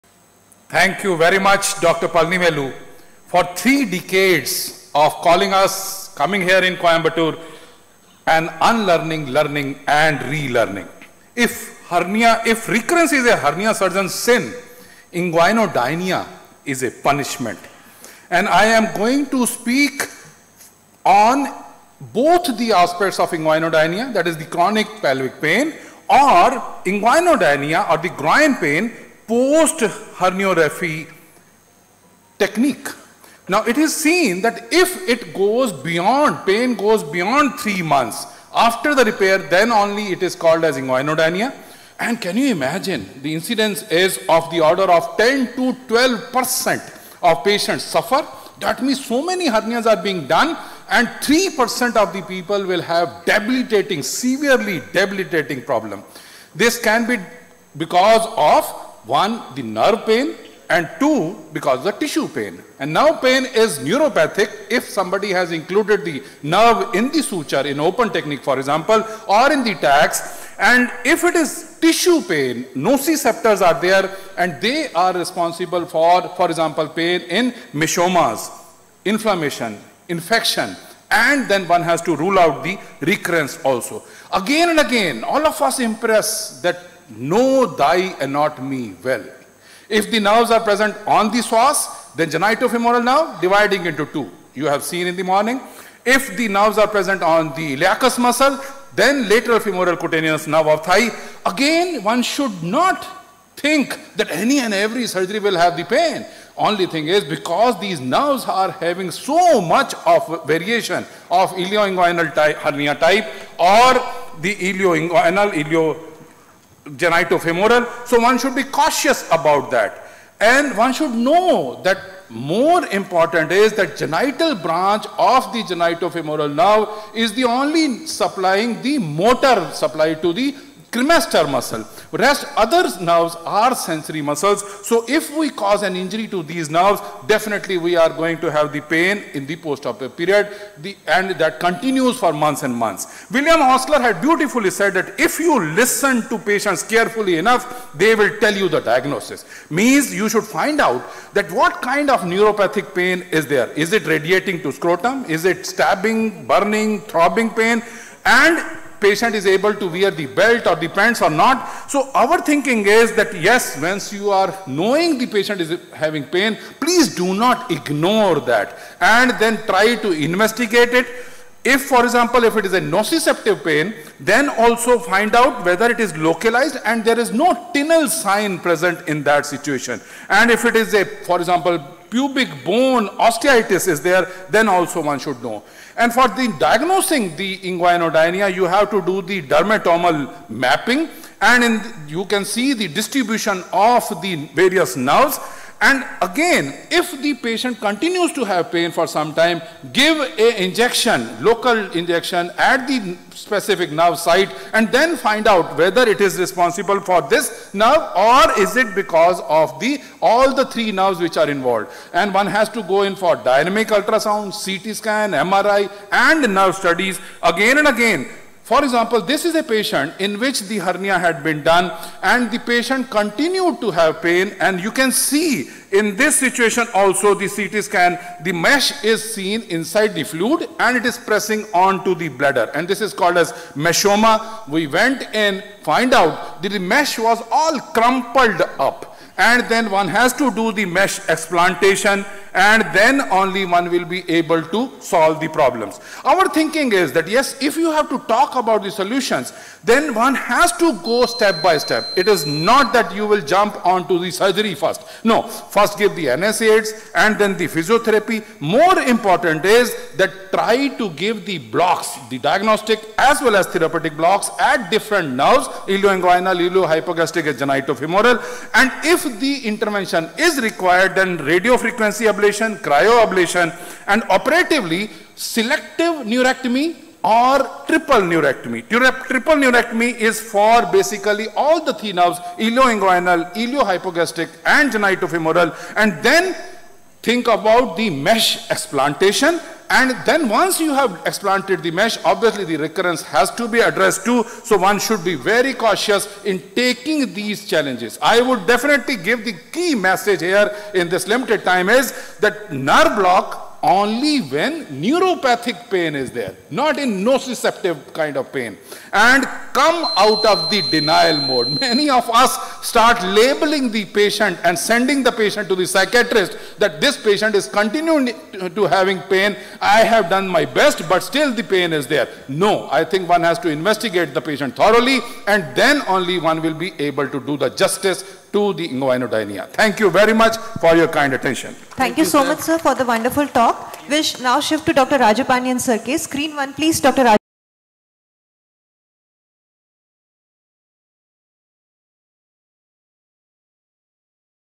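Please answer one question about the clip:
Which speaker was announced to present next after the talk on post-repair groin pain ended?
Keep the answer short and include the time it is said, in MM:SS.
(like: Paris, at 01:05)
Dr. Rajapandian, at 05:34.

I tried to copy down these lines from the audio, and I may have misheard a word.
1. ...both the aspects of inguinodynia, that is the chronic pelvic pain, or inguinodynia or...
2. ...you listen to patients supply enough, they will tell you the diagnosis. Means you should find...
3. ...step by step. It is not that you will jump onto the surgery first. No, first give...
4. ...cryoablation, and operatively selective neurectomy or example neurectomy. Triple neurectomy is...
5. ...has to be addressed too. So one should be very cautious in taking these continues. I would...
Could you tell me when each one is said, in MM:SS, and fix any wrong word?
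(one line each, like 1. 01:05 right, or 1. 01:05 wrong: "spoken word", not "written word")
1. 00:21 right
2. 02:25 wrong: "carefully", not "supply"
3. 04:11 right
4. 04:32 wrong: "triple", not "example"
5. 04:53 wrong: "challenges", not "continues".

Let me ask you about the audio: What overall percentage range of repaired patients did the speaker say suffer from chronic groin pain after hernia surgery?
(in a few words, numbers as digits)
10 to 12 percent.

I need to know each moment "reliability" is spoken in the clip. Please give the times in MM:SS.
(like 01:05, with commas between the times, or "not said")
not said.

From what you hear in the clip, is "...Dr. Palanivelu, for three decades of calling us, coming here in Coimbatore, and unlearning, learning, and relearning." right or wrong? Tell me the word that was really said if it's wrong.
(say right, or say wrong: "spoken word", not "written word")
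right.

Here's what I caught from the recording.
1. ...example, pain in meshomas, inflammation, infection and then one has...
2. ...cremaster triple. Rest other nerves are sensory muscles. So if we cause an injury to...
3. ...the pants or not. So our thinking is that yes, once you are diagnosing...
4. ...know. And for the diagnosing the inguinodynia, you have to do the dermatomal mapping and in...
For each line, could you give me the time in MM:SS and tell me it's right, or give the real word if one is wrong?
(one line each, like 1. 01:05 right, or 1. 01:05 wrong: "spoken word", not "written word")
1. 01:16 right
2. 02:10 wrong: "muscle", not "triple"
3. 02:40 wrong: "knowing", not "diagnosing"
4. 03:05 right.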